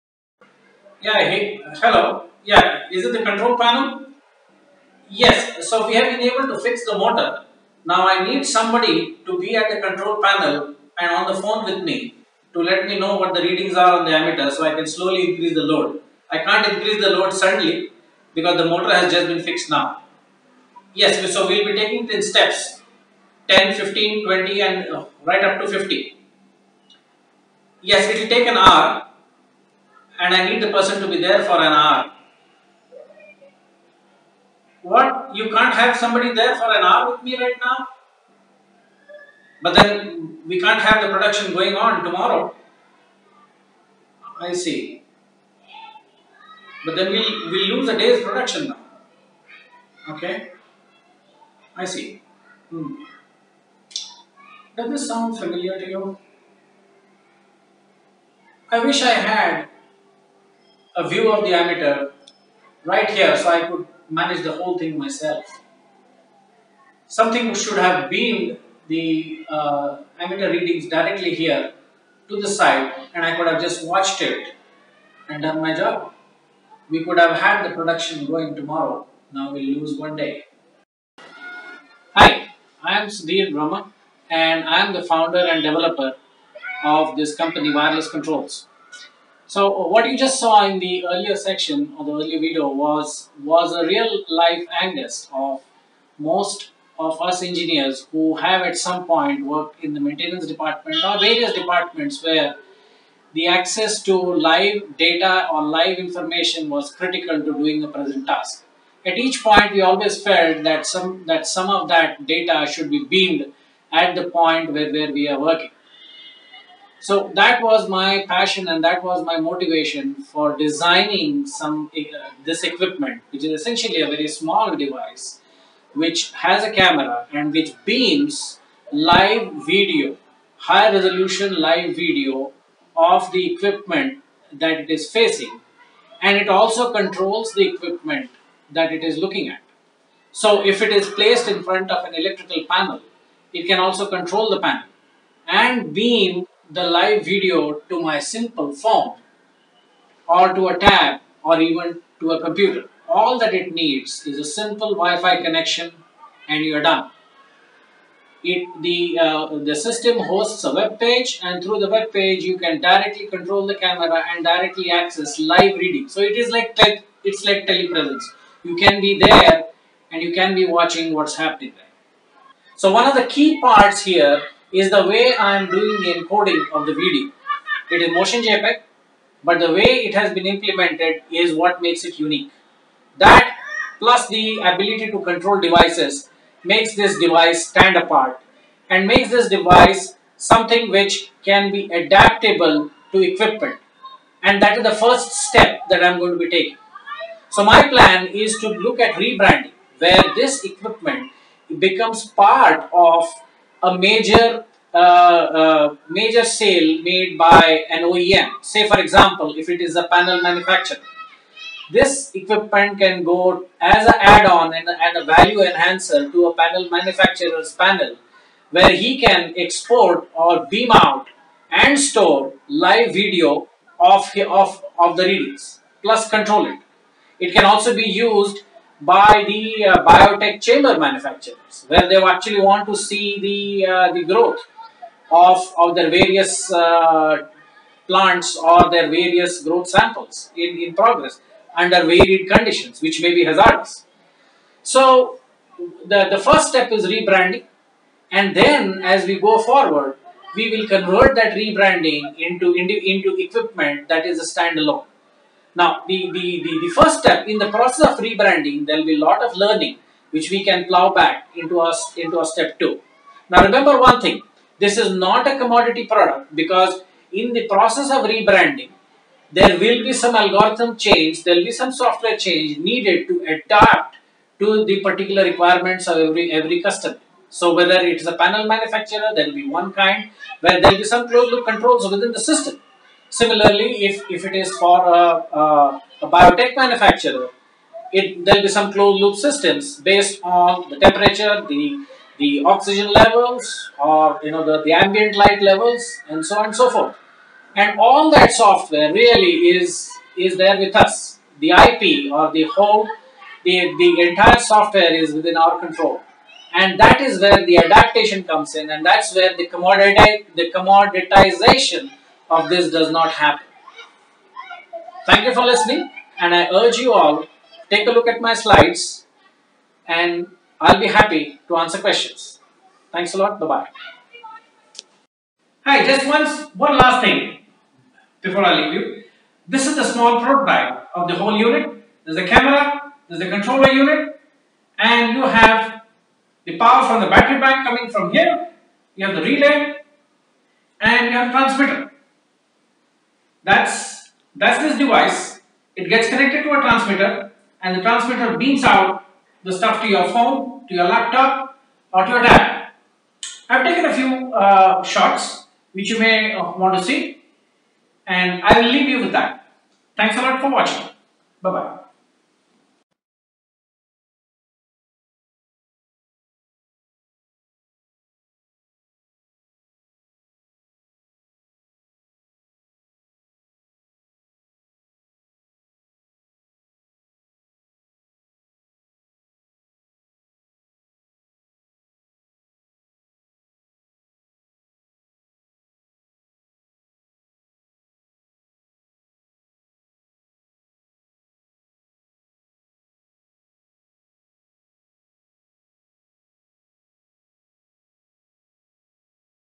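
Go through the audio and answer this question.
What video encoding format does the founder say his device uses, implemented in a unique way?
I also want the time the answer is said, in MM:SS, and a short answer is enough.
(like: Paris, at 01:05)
motion JPEG, at 02:58.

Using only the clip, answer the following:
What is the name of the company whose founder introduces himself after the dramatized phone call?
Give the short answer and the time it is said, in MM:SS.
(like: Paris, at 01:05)
Wireless Controls, at 01:27.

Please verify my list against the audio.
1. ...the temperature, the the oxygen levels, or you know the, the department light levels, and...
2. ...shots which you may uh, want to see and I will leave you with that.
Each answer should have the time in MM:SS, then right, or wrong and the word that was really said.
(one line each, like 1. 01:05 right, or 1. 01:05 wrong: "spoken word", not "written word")
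1. 04:50 wrong: "ambient", not "department"
2. 05:55 right.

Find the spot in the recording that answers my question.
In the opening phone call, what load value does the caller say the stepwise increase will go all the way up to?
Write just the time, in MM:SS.
00:25.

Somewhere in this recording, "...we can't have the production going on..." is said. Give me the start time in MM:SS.
00:40.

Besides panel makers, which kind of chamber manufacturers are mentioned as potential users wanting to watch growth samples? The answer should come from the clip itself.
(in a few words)
biotech chamber manufacturers.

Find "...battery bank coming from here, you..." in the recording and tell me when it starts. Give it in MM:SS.
05:37.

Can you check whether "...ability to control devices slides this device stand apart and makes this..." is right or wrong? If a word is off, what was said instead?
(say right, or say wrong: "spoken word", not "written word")
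wrong: "makes", not "slides".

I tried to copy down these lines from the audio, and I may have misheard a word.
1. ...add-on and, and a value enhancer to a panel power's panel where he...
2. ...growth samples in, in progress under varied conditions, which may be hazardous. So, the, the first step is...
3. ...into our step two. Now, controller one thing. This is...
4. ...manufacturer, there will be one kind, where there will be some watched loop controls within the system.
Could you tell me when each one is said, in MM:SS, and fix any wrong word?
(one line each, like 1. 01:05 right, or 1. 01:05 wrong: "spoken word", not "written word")
1. 03:34 wrong: "manufacturer", not "power"
2. 03:59 right
3. 04:22 wrong: "remember", not "controller"
4. 04:38 wrong: "closed", not "watched".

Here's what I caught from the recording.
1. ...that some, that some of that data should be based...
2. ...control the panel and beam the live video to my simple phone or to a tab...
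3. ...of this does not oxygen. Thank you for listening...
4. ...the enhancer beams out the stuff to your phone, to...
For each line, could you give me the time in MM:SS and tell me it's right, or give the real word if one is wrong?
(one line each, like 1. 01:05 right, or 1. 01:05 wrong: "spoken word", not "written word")
1. 01:50 wrong: "beamed", not "based"
2. 02:24 right
3. 05:12 wrong: "happen", not "oxygen"
4. 05:47 wrong: "transmitter", not "enhancer".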